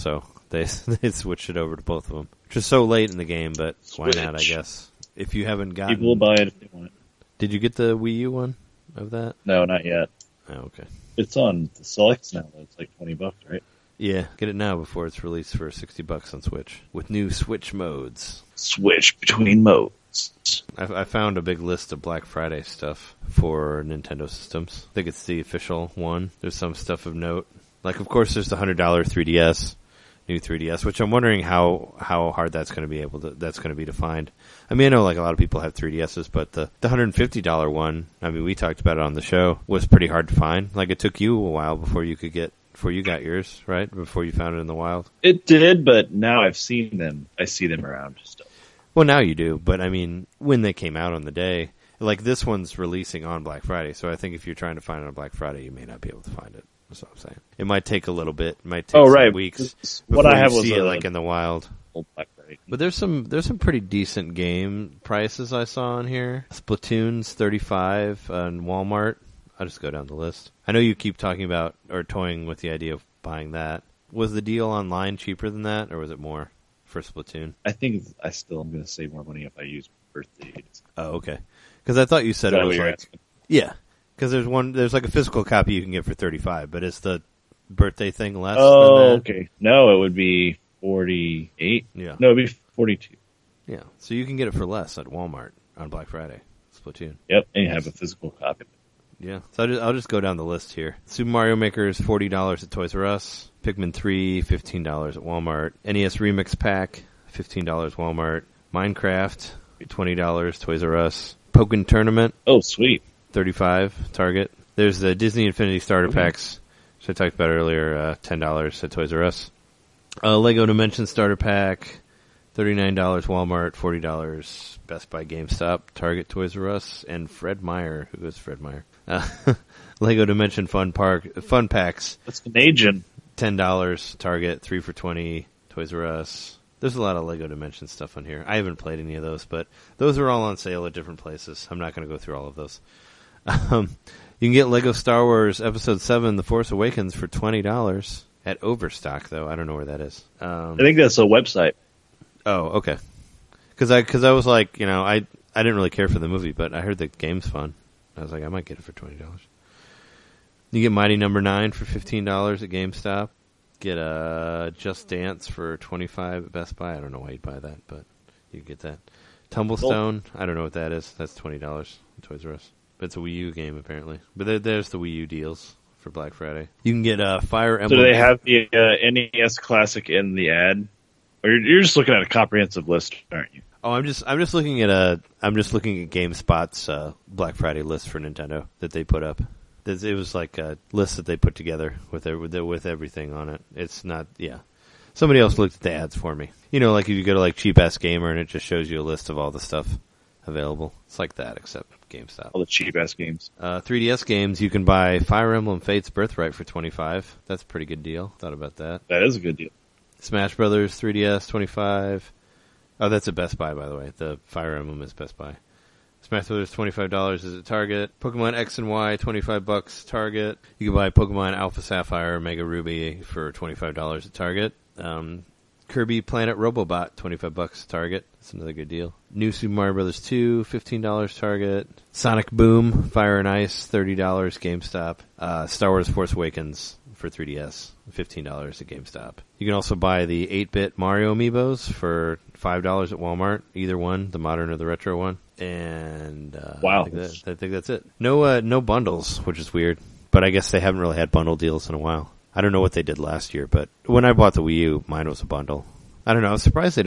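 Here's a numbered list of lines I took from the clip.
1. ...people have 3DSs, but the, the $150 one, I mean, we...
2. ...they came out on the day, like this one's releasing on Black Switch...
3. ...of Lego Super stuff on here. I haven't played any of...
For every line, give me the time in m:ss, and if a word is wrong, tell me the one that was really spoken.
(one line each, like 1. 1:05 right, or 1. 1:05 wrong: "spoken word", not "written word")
1. 0:35 right
2. 0:50 wrong: "Friday", not "Switch"
3. 2:17 wrong: "Dimension", not "Super".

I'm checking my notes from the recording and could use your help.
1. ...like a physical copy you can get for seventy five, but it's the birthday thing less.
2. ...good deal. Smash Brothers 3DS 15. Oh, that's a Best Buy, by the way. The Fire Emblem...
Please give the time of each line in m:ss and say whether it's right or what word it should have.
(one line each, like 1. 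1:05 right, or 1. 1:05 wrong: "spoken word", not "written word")
1. 1:24 wrong: "thirty", not "seventy"
2. 3:29 wrong: "25", not "15".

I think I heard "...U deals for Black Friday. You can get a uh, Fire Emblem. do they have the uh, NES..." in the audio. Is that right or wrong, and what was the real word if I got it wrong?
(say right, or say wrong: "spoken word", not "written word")
right.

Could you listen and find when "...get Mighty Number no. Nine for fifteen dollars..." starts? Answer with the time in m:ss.
2:40.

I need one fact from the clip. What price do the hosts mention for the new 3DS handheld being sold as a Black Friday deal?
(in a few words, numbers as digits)
$100.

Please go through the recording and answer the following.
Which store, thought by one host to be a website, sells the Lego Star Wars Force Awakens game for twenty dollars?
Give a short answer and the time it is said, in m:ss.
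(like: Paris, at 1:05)
Overstock, at 2:28.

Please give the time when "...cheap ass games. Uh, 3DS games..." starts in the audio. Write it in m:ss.
3:22.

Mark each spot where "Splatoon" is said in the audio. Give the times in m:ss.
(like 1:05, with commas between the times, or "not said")
1:06, 1:16, 1:36.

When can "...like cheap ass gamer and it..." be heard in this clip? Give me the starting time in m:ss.
3:17.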